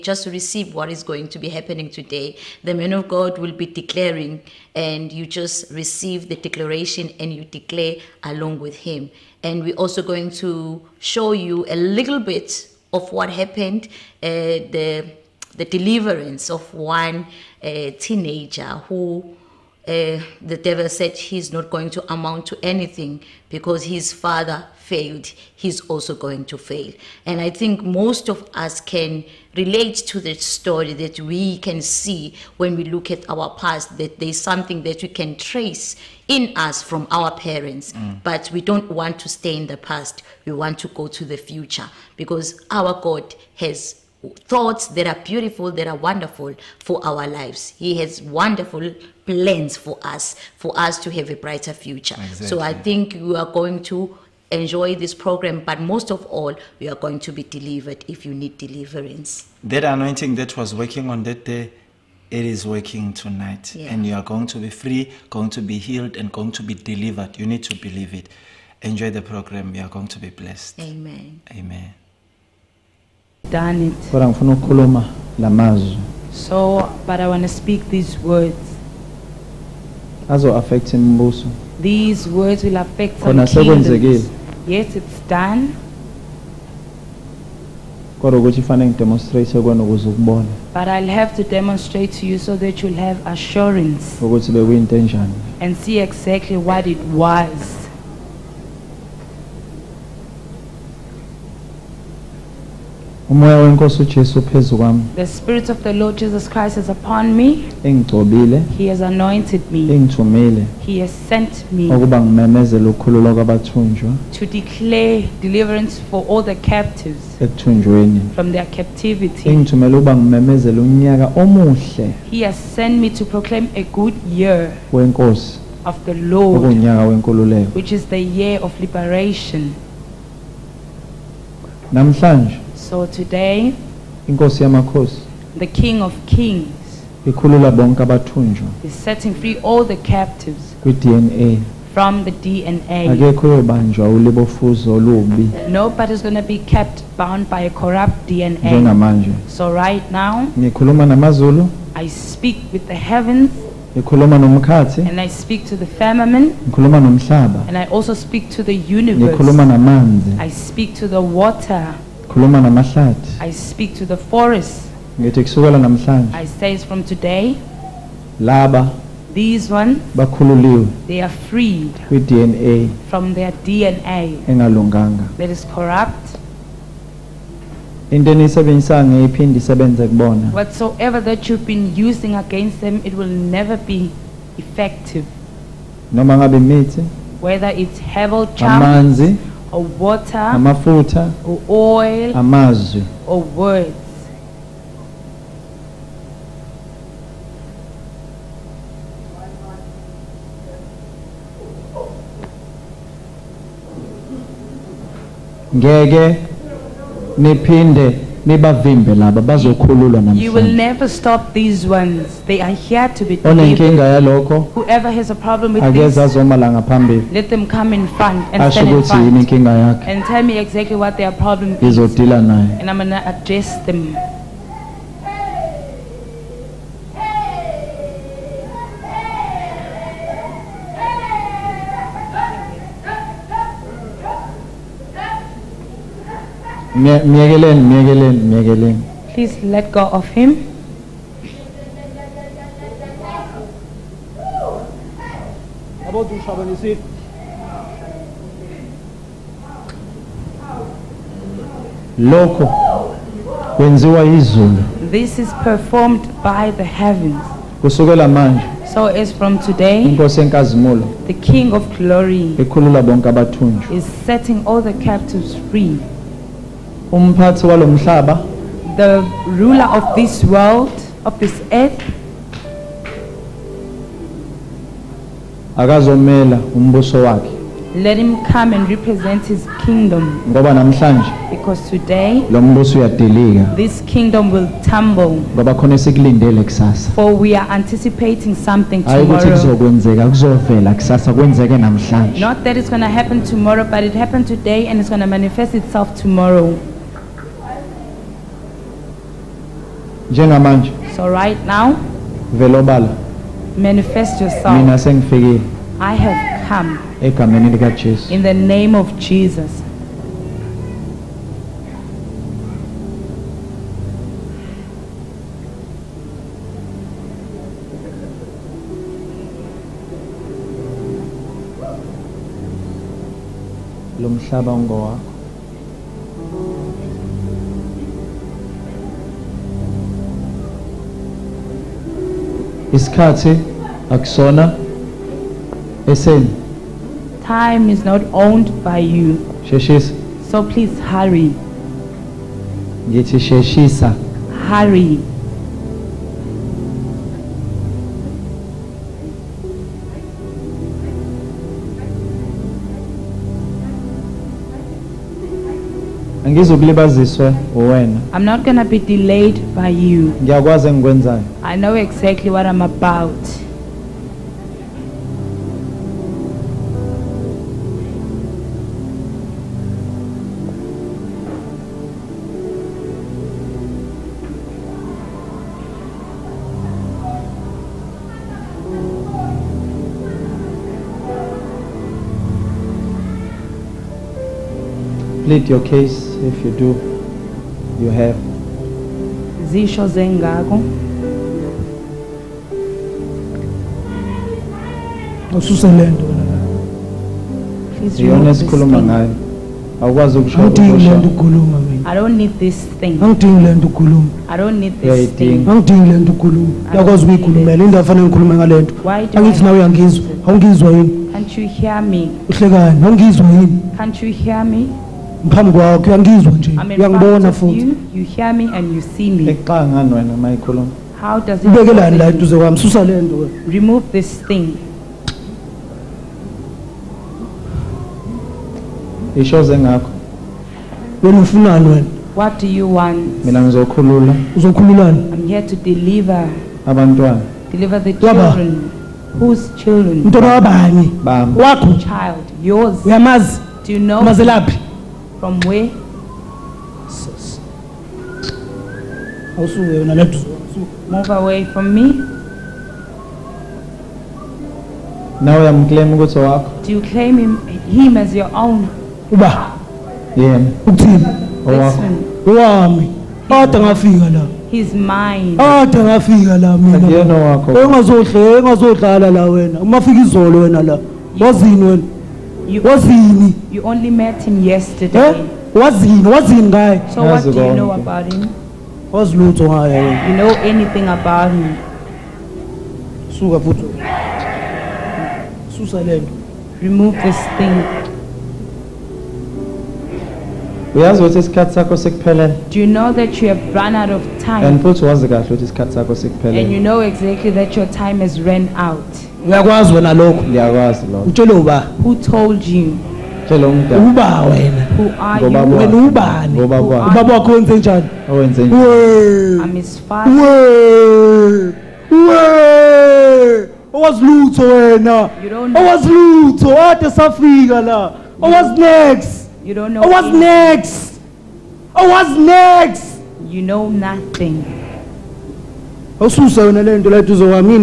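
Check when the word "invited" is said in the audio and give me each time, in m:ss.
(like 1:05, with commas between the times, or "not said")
not said.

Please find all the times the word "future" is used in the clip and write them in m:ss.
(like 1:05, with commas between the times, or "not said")
0:41, 0:51.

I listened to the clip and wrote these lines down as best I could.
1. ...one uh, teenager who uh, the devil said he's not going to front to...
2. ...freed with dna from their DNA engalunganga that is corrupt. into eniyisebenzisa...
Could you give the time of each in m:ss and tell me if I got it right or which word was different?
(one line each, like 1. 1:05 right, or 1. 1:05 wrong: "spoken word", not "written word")
1. 0:16 wrong: "amount", not "front"
2. 2:51 right.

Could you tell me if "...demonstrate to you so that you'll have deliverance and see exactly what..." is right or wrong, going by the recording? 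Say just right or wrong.
wrong.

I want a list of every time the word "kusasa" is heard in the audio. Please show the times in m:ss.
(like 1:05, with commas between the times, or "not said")
4:46, 4:50.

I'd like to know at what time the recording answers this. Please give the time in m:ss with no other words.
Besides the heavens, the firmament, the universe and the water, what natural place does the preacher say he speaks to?
2:44.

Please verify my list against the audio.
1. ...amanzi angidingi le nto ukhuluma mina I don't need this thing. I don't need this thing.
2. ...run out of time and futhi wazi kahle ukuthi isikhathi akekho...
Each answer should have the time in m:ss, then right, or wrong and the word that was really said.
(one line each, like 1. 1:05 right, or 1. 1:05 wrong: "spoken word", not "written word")
1. 6:40 wrong: "awukwazi", not "amanzi"
2. 8:13 wrong: "sakho", not "akekho".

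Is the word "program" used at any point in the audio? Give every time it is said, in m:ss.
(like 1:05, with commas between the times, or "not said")
0:55, 1:09.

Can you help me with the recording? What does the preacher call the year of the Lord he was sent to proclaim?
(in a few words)
the year of liberation.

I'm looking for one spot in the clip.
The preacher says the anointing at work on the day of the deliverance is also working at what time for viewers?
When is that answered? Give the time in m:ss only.
1:03.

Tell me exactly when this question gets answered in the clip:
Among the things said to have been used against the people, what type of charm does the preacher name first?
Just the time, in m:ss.
3:07.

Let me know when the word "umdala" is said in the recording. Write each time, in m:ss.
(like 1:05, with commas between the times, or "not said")
8:23.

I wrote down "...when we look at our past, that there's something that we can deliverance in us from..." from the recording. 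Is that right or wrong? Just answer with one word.
wrong.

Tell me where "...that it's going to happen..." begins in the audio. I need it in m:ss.
4:52.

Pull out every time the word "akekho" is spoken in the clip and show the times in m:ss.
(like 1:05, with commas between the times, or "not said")
2:23.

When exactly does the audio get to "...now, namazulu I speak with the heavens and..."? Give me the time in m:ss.
2:30.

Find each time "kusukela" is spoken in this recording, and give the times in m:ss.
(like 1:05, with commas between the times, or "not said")
2:45.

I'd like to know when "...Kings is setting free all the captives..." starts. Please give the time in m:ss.
2:16.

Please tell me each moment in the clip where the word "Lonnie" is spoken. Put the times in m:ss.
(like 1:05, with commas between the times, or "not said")
not said.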